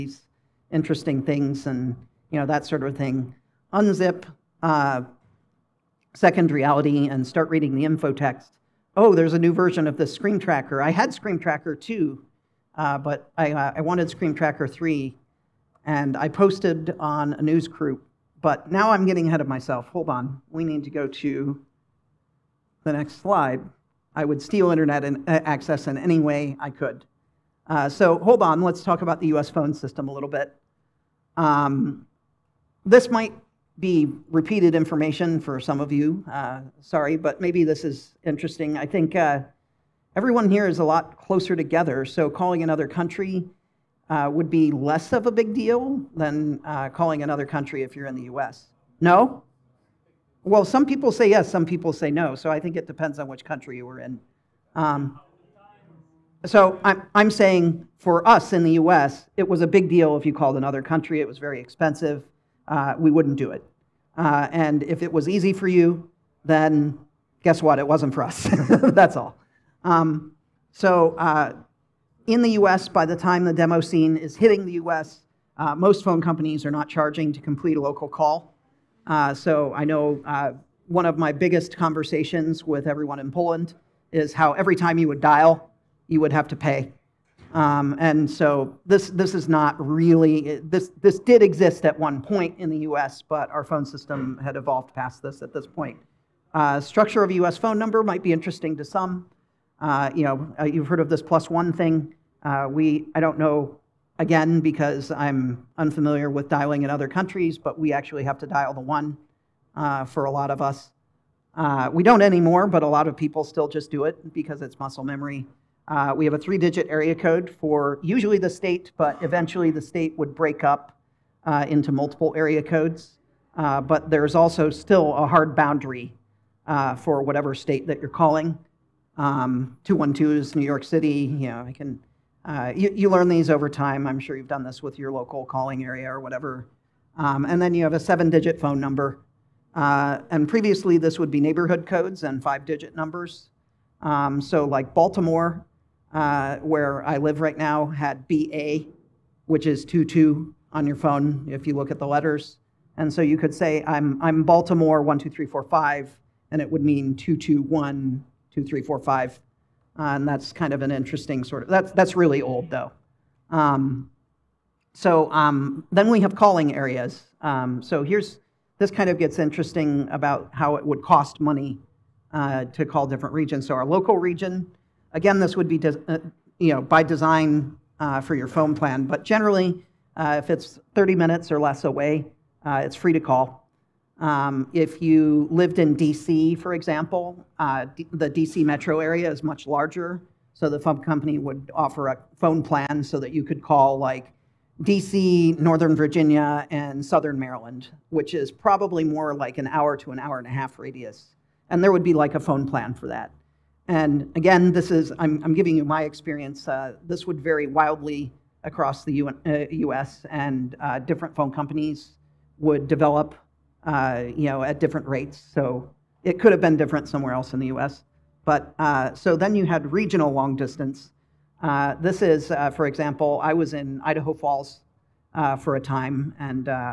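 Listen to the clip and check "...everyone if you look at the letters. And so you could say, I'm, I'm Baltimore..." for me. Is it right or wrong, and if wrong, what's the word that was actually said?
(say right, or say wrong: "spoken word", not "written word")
wrong: "phone", not "everyone".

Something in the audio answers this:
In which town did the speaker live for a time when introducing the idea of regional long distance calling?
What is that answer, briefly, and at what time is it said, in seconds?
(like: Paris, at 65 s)
Idaho Falls, at 224 s.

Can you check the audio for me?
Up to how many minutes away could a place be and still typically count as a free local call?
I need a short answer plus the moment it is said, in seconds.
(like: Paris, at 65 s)
30 minutes, at 180 s.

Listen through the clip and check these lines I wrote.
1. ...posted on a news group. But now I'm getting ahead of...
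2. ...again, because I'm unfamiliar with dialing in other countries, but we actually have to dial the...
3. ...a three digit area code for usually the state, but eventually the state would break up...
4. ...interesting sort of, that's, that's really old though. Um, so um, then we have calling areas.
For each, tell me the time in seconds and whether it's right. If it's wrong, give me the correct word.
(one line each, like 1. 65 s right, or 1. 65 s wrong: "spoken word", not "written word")
1. 16 s right
2. 104 s right
3. 116 s right
4. 160 s right.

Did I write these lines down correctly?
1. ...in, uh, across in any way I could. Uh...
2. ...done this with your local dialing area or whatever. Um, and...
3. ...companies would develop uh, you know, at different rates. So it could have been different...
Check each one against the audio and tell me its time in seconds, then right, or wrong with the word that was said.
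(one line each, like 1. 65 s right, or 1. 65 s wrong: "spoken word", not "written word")
1. 25 s wrong: "access", not "across"
2. 134 s wrong: "calling", not "dialing"
3. 211 s right.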